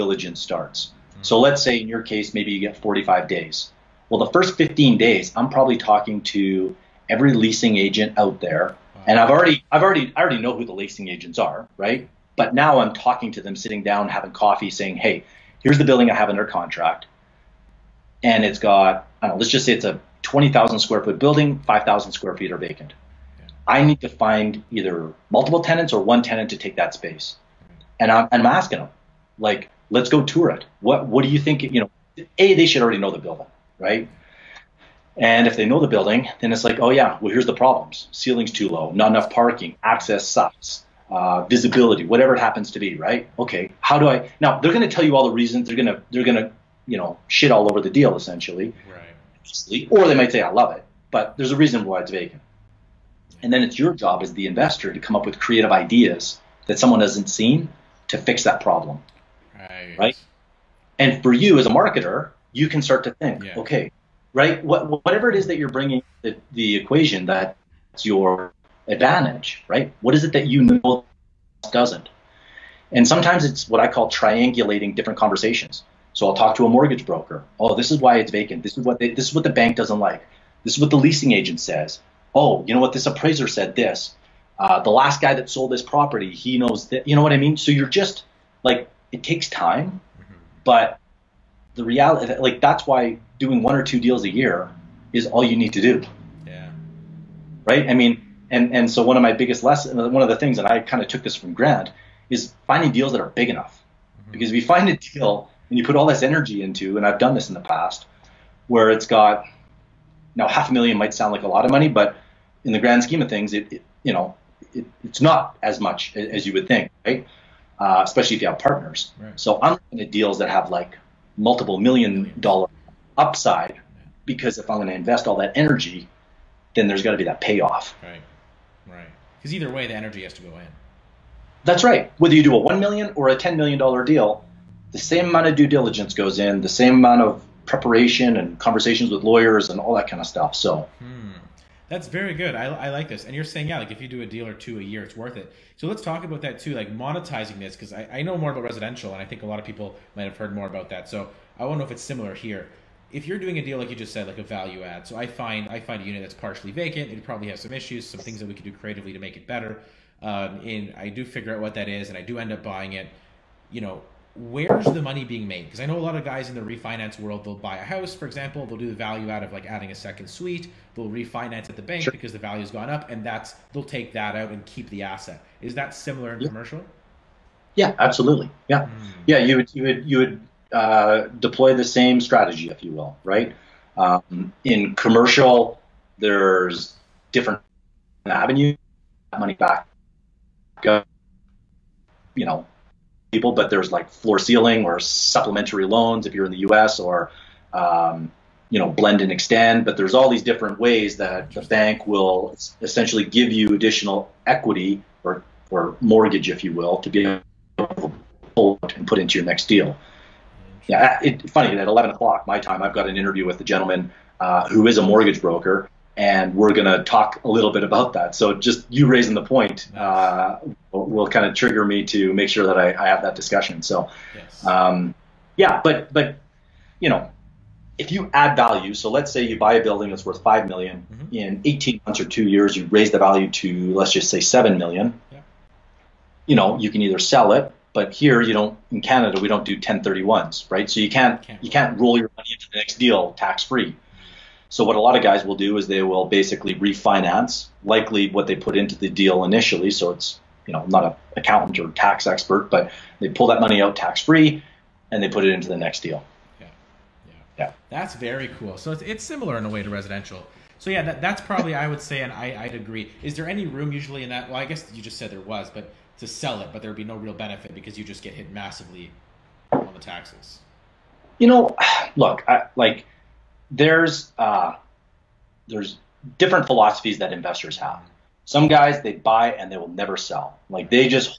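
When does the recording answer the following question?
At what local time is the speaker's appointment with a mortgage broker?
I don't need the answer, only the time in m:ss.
3:31.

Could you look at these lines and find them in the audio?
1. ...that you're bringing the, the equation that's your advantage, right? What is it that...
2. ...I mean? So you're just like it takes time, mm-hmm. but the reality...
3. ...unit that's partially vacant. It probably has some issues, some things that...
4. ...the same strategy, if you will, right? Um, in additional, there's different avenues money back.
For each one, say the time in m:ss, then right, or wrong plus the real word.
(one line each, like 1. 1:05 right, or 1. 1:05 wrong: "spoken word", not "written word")
1. 1:05 right
2. 1:27 right
3. 2:36 right
4. 3:01 wrong: "commercial", not "additional".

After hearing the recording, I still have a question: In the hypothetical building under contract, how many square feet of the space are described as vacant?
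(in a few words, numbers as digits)
5,000.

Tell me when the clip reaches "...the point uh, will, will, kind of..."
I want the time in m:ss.
3:39.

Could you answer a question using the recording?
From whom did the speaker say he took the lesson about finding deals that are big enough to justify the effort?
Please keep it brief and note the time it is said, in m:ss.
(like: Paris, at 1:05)
Grant, at 1:41.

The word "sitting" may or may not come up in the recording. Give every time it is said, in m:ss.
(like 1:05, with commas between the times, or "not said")
0:13.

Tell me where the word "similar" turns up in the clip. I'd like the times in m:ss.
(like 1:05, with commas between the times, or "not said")
2:32, 2:55, 4:19.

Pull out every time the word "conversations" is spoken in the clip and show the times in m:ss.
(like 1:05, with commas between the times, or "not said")
1:15, 2:18.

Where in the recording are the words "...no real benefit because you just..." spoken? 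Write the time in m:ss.
4:27.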